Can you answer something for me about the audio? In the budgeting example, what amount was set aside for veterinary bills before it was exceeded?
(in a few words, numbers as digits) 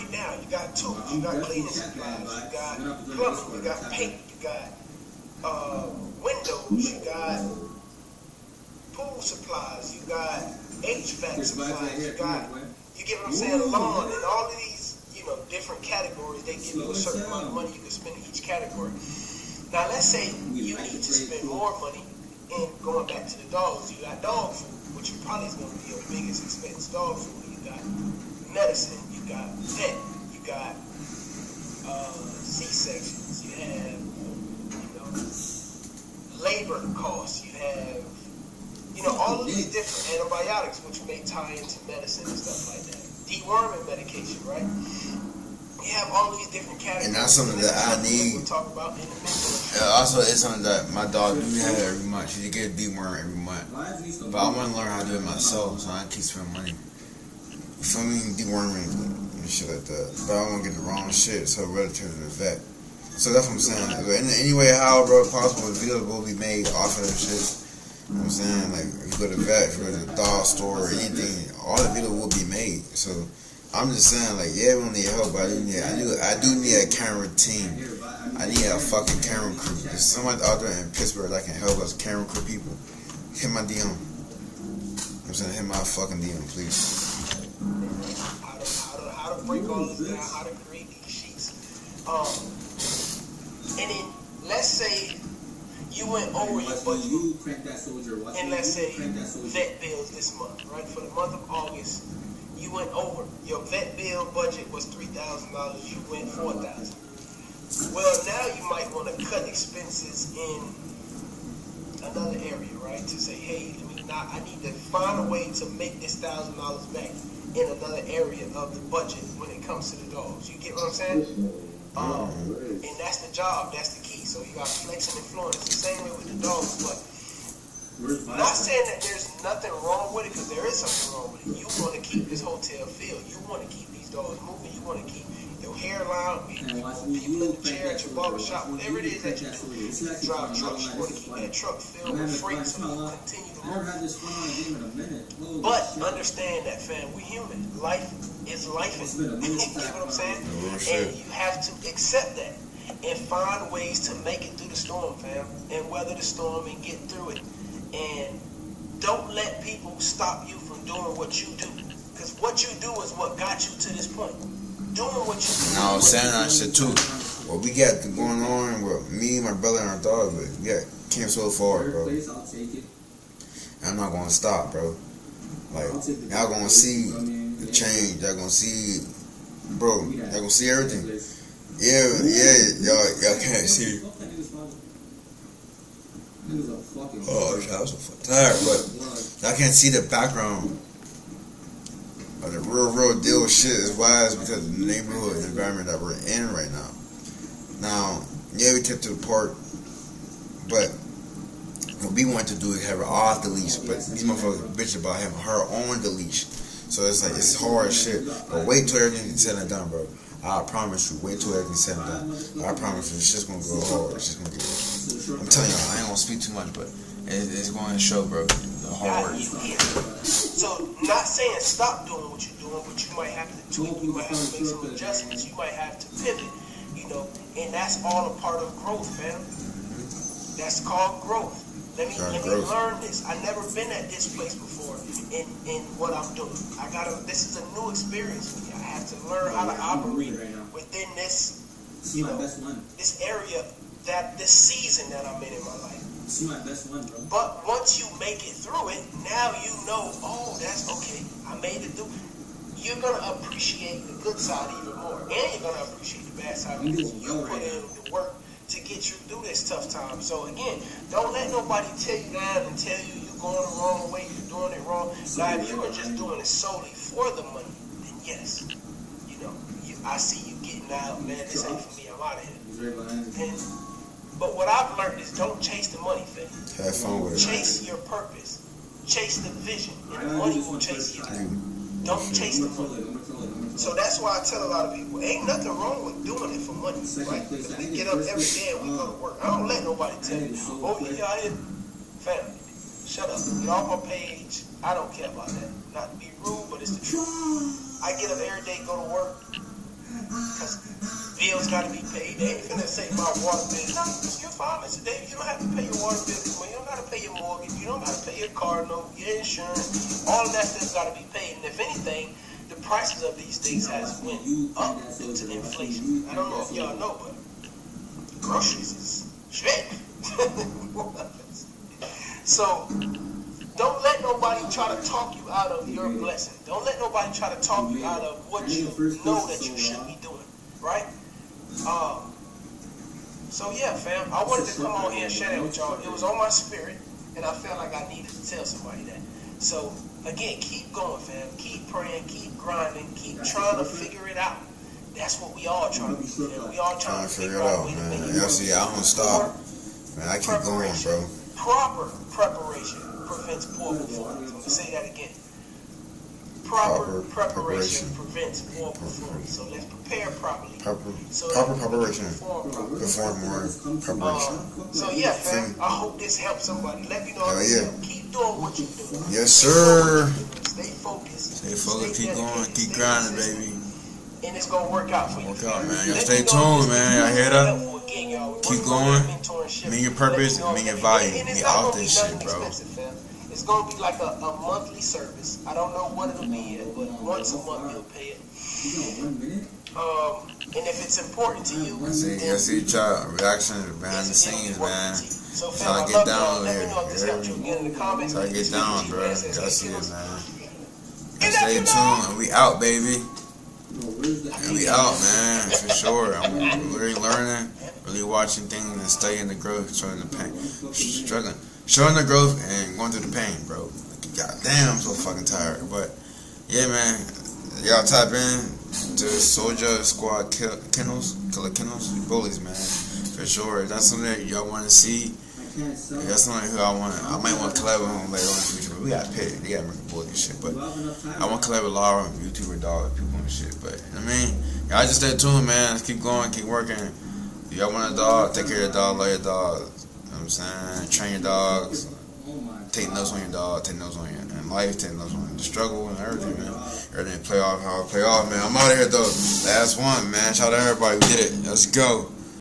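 $3,000.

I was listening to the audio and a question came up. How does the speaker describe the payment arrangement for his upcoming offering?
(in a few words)
a monthly service.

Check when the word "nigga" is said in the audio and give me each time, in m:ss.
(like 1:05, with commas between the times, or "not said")
not said.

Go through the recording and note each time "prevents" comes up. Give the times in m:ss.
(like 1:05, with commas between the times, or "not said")
5:53, 5:58.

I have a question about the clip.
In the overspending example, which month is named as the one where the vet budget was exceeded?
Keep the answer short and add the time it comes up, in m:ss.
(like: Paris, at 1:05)
August, at 1:41.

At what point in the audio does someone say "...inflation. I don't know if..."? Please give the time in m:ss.
5:15.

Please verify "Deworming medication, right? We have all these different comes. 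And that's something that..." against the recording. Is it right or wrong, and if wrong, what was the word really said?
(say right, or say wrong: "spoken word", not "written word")
wrong: "categories", not "comes".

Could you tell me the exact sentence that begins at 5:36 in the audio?
It was on my spirit, and I felt like I needed to tell somebody that.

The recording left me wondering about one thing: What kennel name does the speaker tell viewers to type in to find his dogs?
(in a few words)
Soldier Squad Kennels.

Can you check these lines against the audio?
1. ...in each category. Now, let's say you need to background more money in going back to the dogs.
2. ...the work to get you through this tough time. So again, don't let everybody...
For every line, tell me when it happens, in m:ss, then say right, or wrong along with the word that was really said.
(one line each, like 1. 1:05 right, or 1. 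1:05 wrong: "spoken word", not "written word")
1. 0:18 wrong: "spend", not "background"
2. 4:17 wrong: "nobody", not "everybody".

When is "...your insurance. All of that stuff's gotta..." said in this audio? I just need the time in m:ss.
5:09.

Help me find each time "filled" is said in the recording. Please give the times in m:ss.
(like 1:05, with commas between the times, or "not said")
2:12, 2:21.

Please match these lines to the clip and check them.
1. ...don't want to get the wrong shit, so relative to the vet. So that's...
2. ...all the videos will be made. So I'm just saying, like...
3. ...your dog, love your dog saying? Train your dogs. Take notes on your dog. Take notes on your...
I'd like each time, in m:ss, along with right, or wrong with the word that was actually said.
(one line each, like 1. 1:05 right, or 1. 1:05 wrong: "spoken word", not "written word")
1. 1:00 right
2. 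1:11 right
3. 7:18 right.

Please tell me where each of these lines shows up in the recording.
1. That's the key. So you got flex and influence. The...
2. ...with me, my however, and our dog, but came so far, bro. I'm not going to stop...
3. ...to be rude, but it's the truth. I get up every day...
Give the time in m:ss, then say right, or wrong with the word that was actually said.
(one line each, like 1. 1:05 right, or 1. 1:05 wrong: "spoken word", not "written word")
1. 2:03 right
2. 2:48 wrong: "brother", not "however"
3. 4:56 right.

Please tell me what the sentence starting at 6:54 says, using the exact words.
God damn, I'm so fucking tired.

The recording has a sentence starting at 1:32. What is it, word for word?
Um, and it let's say you went over your budget.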